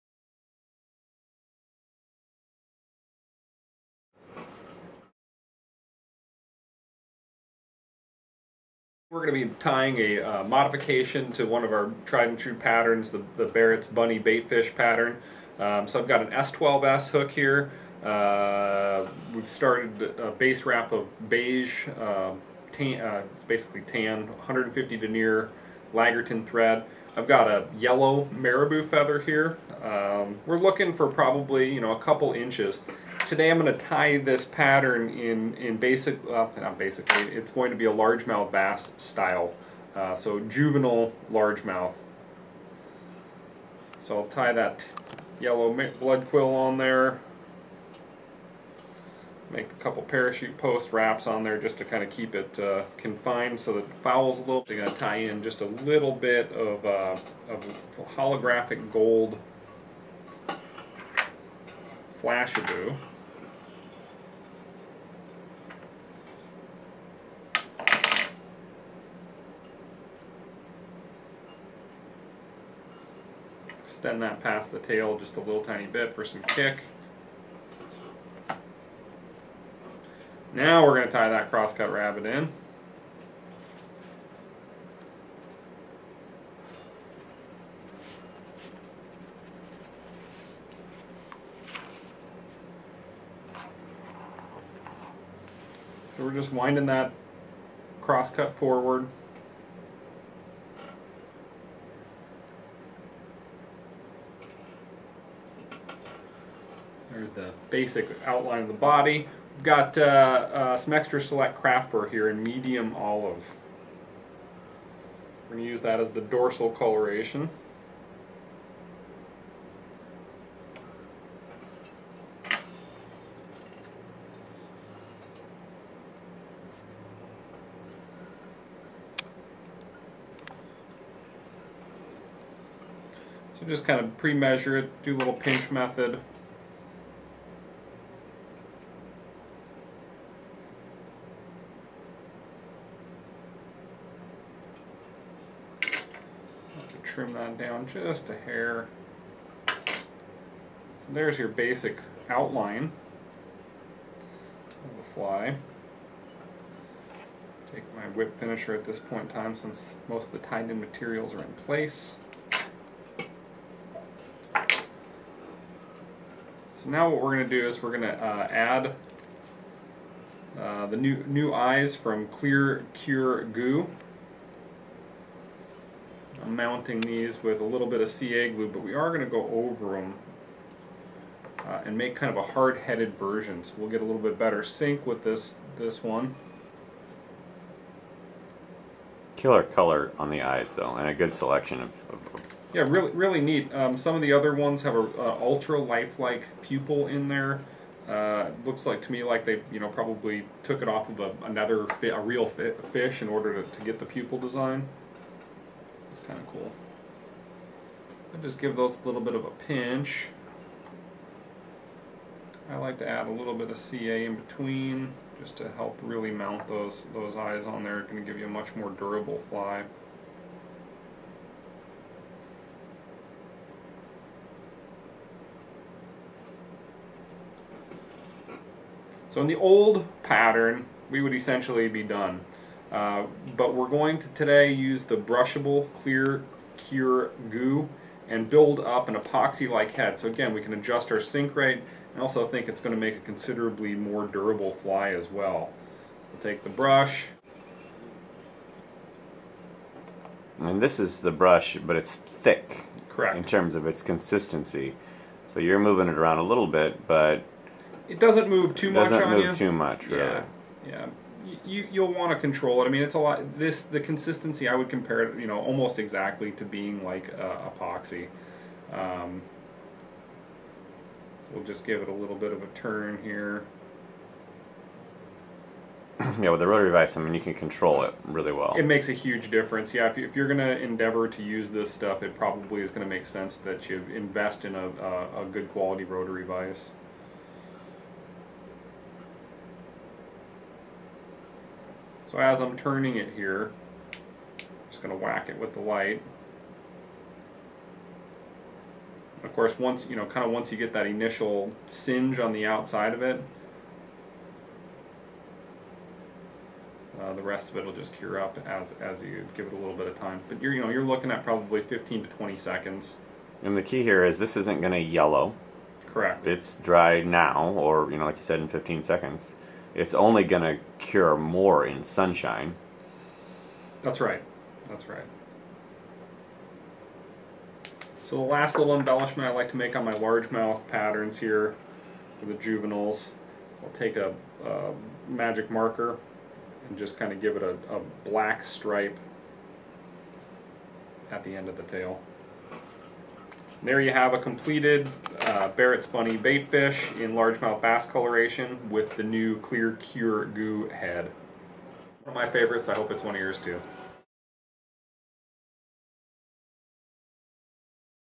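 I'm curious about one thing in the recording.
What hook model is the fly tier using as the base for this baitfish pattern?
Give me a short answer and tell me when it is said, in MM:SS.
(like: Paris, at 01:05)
S12S, at 00:16.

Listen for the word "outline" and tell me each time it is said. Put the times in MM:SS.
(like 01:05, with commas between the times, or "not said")
01:48, 02:32.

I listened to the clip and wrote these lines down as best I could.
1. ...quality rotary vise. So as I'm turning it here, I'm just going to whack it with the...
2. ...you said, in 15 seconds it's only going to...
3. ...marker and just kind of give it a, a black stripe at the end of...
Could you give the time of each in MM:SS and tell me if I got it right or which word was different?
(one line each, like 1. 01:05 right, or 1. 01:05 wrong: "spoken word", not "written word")
1. 04:45 right
2. 05:18 right
3. 05:35 right.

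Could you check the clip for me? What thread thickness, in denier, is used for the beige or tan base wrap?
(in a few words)
150.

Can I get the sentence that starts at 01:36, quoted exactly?
So we're just winding that crosscut forward.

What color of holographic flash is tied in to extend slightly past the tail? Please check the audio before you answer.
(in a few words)
gold.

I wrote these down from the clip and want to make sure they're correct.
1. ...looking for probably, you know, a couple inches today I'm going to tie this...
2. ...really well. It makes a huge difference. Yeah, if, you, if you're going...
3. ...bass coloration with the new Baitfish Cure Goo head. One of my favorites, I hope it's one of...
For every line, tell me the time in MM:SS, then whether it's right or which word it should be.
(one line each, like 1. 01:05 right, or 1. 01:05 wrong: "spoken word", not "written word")
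1. 00:30 right
2. 04:38 right
3. 05:47 wrong: "Clear", not "Baitfish".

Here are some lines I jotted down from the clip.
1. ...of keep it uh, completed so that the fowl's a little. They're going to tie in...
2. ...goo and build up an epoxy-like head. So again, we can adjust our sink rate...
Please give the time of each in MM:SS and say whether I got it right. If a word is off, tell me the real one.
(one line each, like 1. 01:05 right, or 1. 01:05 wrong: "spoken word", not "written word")
1. 00:52 wrong: "confined", not "completed"
2. 03:57 right.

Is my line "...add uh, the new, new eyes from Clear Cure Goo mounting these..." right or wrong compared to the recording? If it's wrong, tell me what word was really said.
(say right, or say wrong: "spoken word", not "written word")
right.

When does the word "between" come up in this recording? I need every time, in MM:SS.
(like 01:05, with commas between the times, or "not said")
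03:34.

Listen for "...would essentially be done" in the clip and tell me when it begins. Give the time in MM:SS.
03:51.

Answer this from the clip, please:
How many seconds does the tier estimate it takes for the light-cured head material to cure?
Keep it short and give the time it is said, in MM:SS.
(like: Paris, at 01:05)
15 to 20, at 05:11.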